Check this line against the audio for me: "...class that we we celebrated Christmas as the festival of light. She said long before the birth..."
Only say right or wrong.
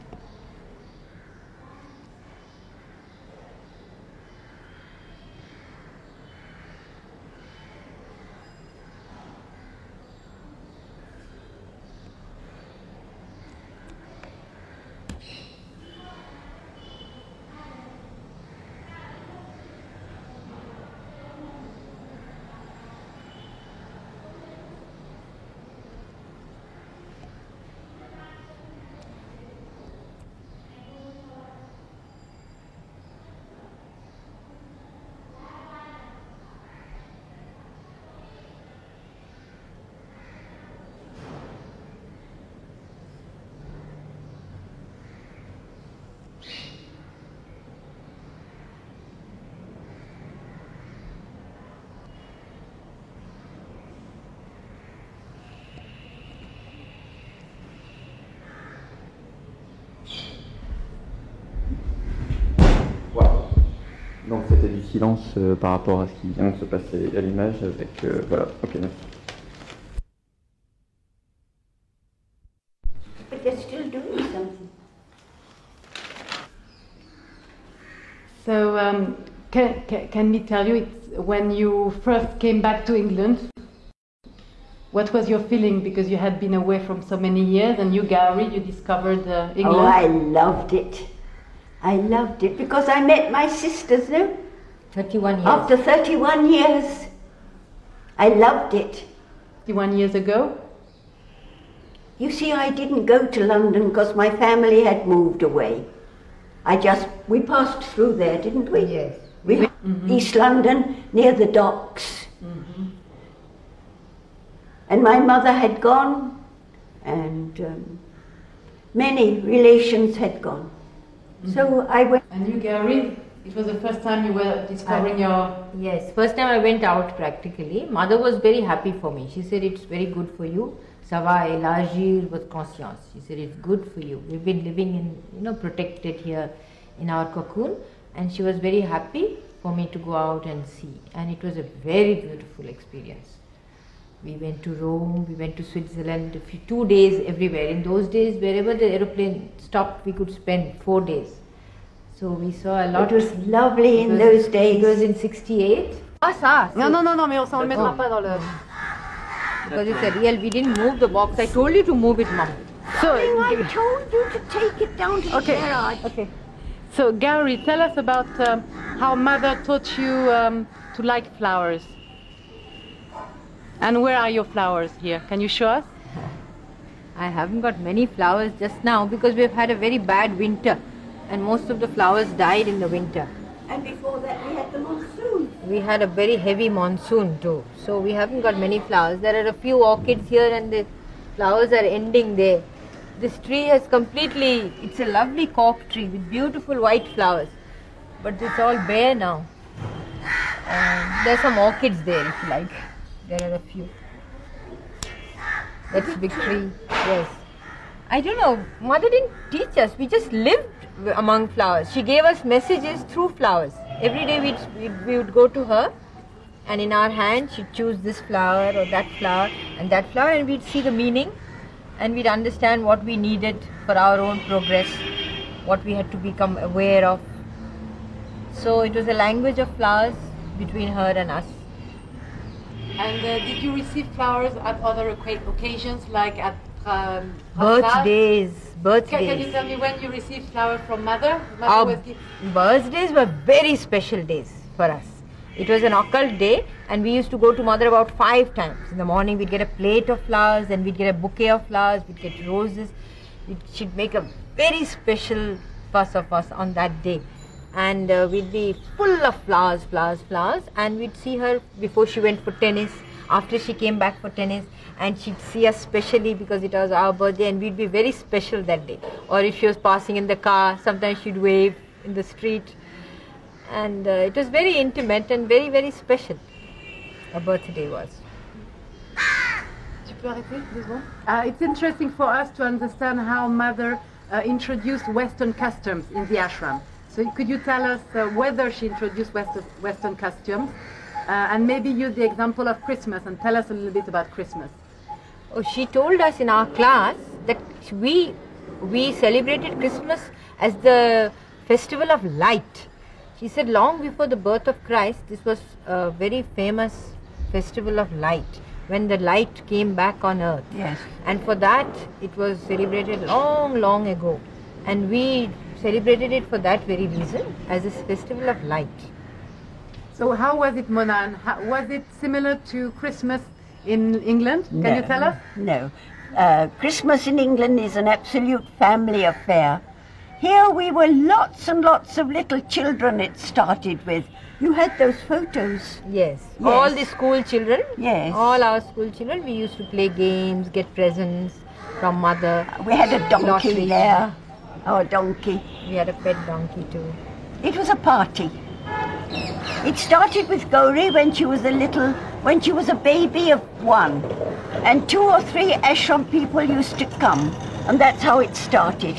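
right.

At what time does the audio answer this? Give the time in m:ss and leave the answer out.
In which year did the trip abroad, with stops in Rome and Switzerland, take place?
2:35.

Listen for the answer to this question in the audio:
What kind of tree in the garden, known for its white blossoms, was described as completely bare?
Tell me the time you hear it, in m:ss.
3:15.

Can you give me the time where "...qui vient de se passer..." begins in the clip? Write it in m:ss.
1:06.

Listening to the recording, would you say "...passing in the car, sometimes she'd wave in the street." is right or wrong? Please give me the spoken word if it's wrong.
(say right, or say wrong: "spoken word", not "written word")
right.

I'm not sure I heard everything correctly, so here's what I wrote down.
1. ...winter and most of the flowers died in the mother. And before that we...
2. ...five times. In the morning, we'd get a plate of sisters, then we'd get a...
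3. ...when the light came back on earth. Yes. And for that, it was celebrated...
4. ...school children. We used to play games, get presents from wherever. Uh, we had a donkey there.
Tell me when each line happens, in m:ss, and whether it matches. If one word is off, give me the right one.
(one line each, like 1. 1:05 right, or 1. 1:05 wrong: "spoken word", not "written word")
1. 3:00 wrong: "winter", not "mother"
2. 4:08 wrong: "flowers", not "sisters"
3. 5:08 right
4. 5:38 wrong: "mother", not "wherever".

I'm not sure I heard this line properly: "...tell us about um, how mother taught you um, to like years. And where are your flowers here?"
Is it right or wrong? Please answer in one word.
wrong.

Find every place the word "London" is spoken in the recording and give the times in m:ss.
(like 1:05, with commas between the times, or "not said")
1:43, 1:50.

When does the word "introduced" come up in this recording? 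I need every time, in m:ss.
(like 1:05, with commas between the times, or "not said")
4:44, 4:48.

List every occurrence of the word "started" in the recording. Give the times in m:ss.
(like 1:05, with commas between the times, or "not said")
5:33, 5:49, 5:58.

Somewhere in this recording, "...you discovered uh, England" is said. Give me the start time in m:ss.
1:28.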